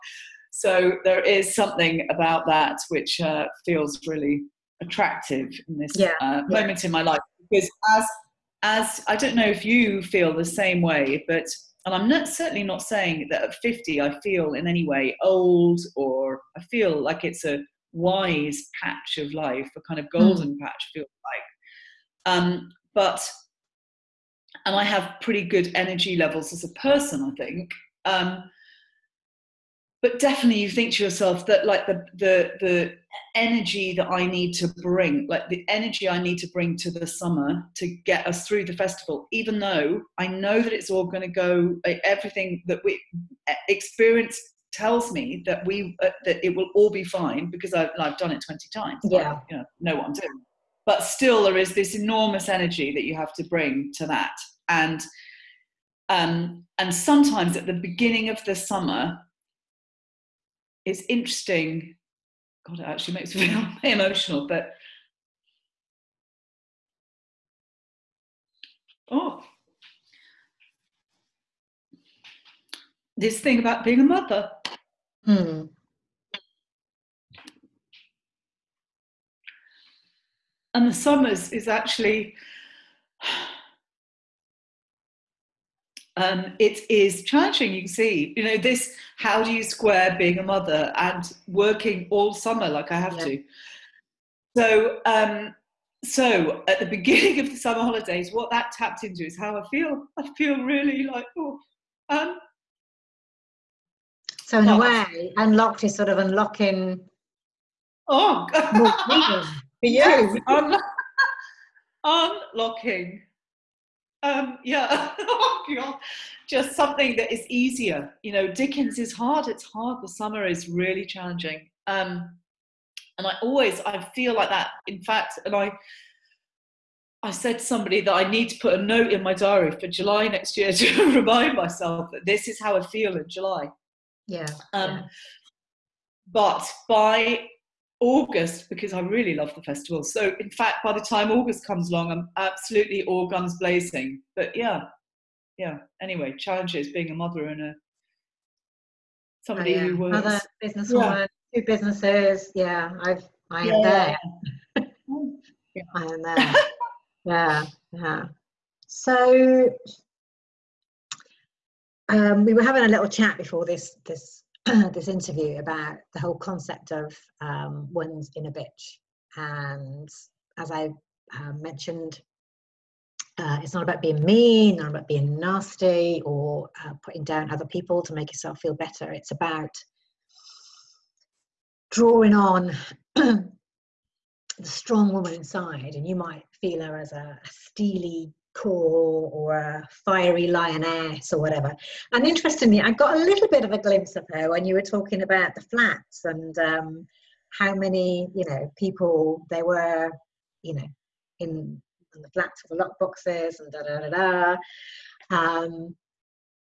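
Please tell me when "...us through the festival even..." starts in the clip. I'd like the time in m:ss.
0:38.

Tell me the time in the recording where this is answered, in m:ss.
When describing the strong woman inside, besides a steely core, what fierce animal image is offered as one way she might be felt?
3:10.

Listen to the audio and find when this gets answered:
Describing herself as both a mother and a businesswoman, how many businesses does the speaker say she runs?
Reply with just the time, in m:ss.
2:31.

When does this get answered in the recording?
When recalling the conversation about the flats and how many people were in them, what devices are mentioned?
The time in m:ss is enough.
3:22.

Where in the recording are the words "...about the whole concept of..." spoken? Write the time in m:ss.
2:45.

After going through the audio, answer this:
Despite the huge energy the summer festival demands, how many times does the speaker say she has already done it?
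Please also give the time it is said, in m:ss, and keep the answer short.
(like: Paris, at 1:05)
20, at 0:48.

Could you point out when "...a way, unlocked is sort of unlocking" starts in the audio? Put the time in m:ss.
1:44.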